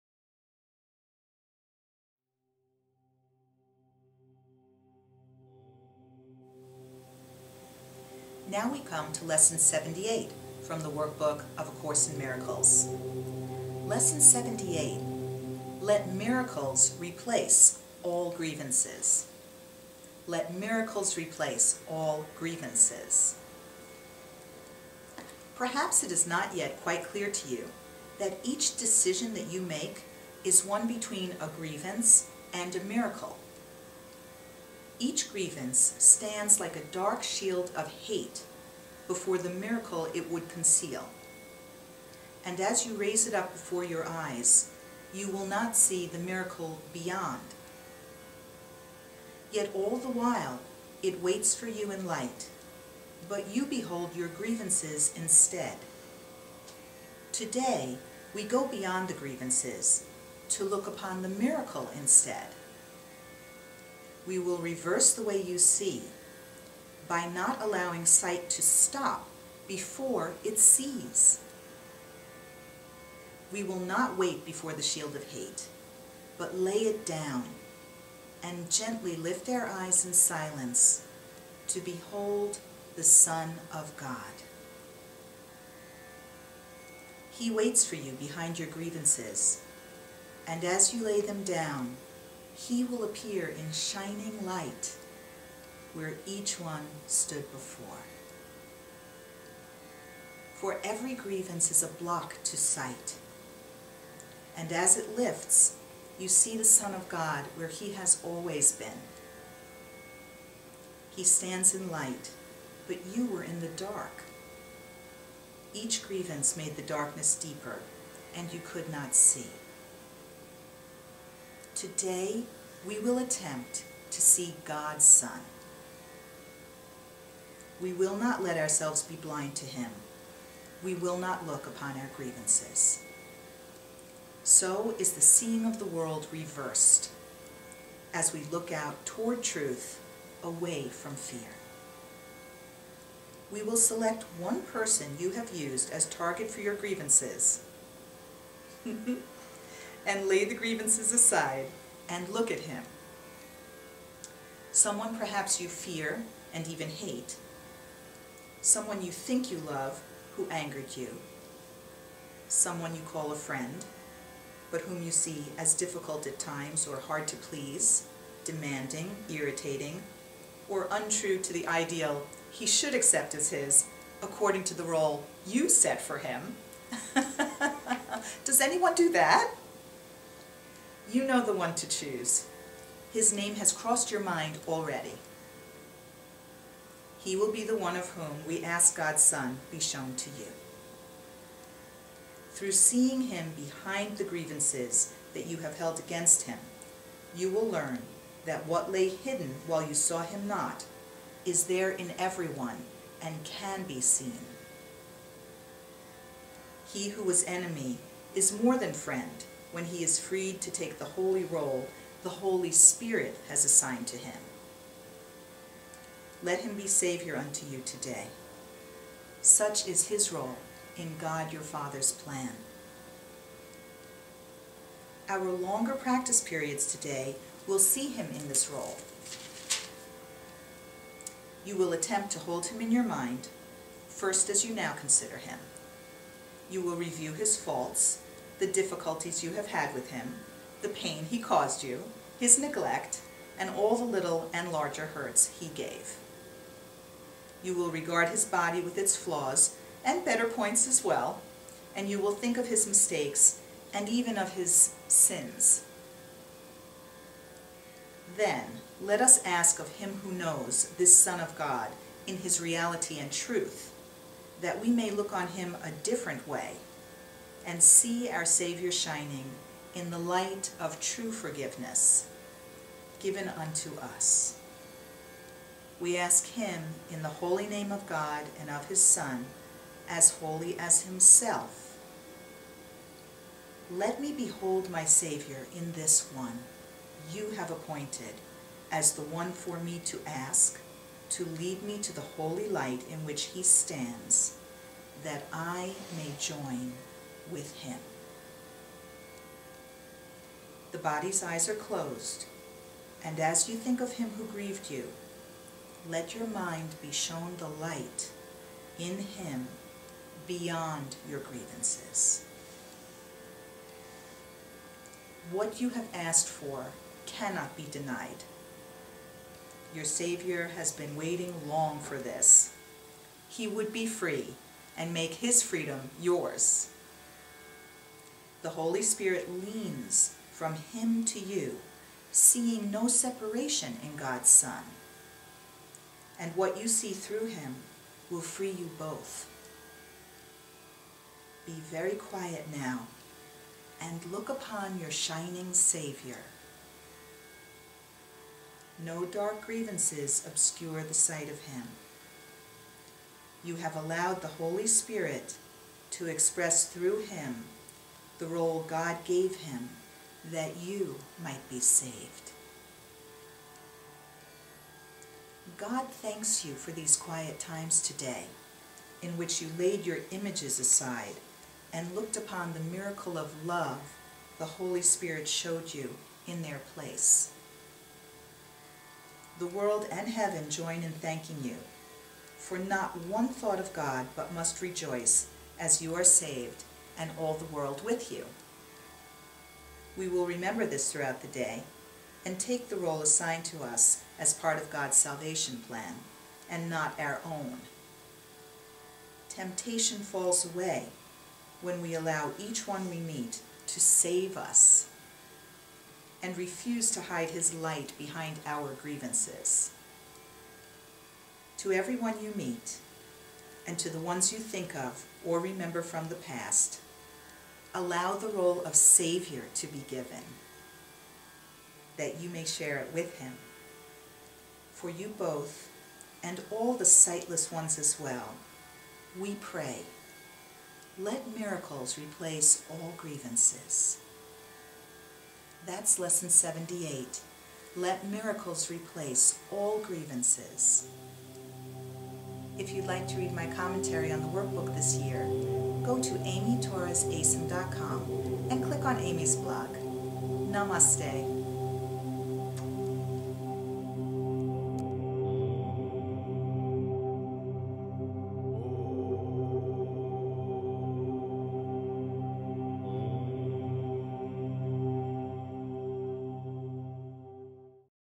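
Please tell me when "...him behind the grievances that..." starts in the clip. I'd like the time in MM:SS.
03:13.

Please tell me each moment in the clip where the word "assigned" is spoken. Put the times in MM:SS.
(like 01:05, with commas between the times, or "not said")
03:33, 06:33.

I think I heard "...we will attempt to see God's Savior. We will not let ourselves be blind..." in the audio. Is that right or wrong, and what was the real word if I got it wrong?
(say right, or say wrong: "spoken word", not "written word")
wrong: "Son", not "Savior".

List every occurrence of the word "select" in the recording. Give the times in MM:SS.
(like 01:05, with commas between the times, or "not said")
02:23.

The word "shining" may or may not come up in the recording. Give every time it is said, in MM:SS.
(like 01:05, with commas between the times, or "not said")
01:33, 04:28, 05:45.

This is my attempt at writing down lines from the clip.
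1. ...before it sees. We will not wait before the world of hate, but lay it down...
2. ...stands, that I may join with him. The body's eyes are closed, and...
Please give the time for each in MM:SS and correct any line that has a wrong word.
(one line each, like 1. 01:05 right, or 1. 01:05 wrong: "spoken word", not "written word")
1. 01:09 wrong: "shield", not "world"
2. 04:53 right.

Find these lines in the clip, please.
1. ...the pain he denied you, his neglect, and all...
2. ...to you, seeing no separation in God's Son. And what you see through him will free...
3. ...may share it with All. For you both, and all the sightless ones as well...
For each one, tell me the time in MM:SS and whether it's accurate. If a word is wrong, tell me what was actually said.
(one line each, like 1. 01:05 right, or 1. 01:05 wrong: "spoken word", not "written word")
1. 04:00 wrong: "caused", not "denied"
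2. 05:31 right
3. 07:02 wrong: "Him", not "All".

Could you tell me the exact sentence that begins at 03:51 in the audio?
You will attempt to hold him in your mind, first as you now consider him.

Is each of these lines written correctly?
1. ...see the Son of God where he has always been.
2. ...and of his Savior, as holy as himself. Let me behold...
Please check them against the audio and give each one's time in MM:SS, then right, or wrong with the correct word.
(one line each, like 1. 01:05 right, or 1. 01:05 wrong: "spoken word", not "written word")
1. 01:46 right
2. 04:38 wrong: "Son", not "Savior".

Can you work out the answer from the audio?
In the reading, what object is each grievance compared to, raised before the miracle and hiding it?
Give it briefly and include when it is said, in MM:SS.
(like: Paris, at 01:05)
dark shield of hate, at 00:36.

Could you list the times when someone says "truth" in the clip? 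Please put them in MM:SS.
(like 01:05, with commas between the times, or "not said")
02:19, 04:23.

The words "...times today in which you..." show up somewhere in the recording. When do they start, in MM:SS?
06:07.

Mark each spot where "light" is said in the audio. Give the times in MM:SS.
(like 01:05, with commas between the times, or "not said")
00:52, 01:34, 01:51, 04:30, 04:52, 05:07, 06:47.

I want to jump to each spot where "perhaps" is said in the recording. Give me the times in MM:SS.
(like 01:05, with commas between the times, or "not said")
00:25, 02:35.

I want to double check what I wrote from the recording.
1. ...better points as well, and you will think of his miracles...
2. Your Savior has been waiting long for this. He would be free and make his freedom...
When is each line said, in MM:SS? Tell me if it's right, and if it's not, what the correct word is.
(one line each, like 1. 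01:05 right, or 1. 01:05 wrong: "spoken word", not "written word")
1. 04:10 wrong: "mistakes", not "miracles"
2. 05:19 right.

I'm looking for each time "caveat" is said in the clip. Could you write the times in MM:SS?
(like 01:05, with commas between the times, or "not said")
not said.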